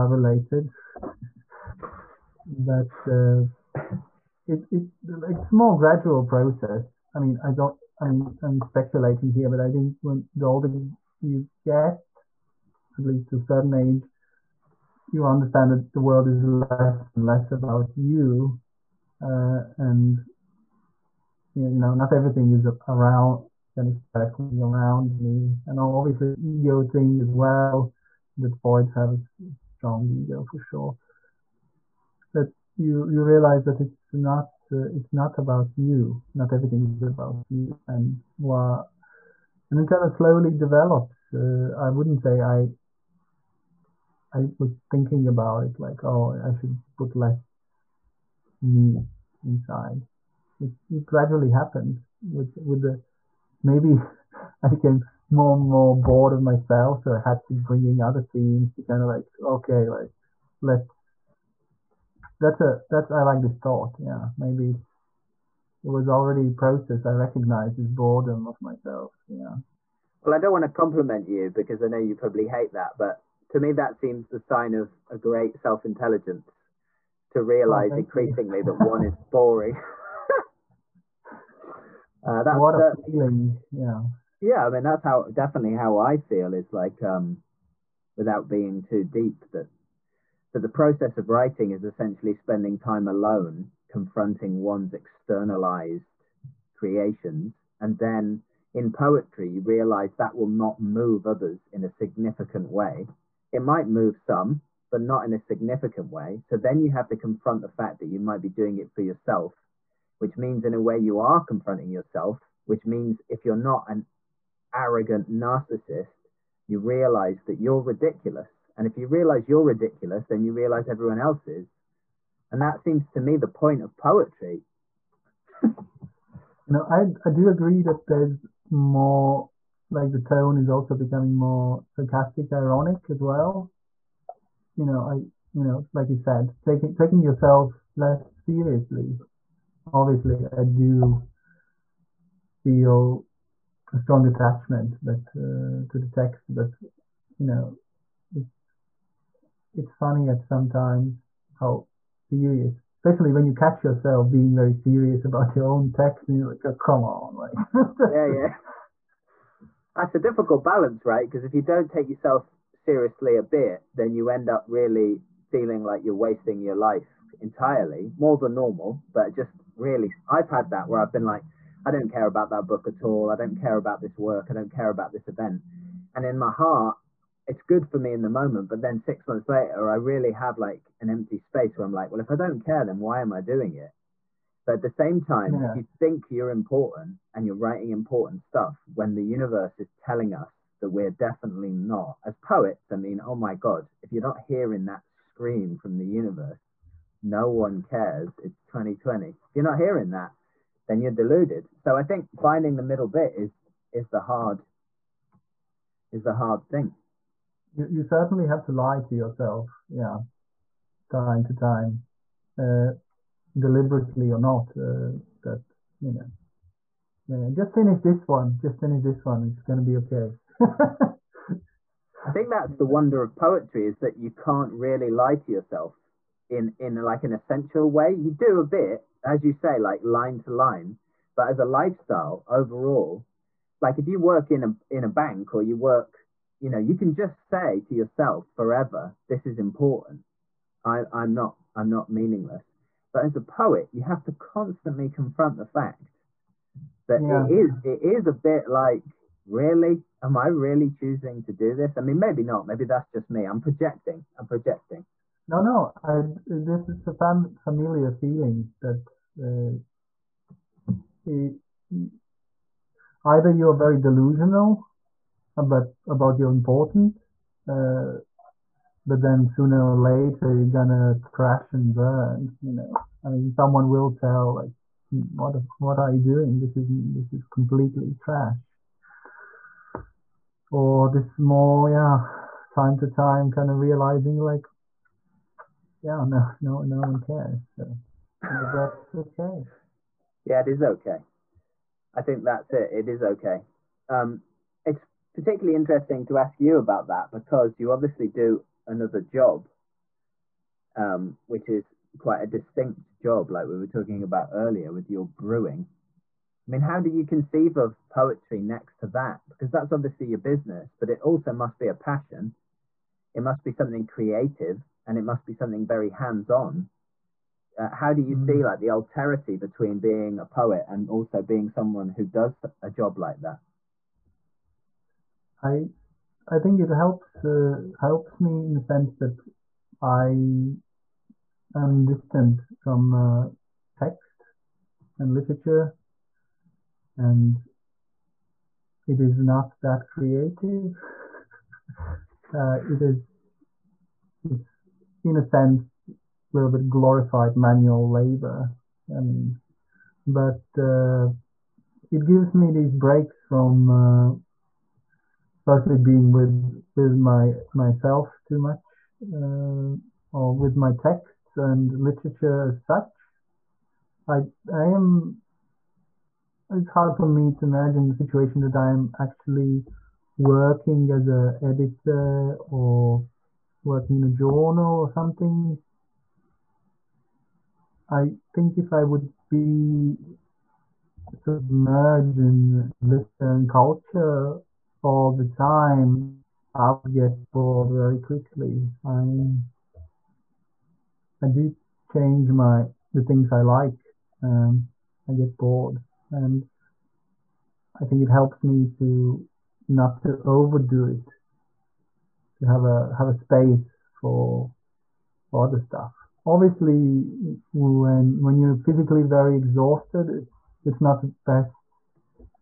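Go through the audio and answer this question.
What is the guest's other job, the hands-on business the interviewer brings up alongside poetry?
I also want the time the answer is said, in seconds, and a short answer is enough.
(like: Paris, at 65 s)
brewing, at 305 s.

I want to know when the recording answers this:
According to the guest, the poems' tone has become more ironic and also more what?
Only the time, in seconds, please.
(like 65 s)
131 s.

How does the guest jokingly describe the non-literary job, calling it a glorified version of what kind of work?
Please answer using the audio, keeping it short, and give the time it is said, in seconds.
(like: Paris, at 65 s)
manual labor, at 347 s.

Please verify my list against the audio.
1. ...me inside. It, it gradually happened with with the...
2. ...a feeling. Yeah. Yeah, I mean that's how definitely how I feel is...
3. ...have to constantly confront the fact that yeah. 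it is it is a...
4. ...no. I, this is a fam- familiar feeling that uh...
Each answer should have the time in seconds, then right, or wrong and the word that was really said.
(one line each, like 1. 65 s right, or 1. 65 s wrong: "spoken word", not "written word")
1. 48 s right
2. 82 s right
3. 244 s right
4. 255 s right.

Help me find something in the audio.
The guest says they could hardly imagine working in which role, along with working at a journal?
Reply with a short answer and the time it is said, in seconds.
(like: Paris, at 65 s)
editor, at 371 s.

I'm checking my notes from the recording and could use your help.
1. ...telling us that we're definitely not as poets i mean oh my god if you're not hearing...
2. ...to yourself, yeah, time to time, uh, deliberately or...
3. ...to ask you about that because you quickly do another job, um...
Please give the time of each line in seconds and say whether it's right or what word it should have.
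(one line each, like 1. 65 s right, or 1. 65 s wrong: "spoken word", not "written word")
1. 189 s right
2. 209 s right
3. 296 s wrong: "obviously", not "quickly".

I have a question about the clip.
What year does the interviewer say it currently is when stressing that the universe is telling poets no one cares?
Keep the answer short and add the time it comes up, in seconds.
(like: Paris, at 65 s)
2020, at 198 s.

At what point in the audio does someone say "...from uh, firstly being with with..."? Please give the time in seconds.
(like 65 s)
353 s.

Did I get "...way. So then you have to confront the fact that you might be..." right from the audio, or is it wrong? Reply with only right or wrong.
right.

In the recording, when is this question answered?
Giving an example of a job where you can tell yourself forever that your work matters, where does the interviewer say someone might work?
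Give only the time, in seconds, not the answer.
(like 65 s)
235 s.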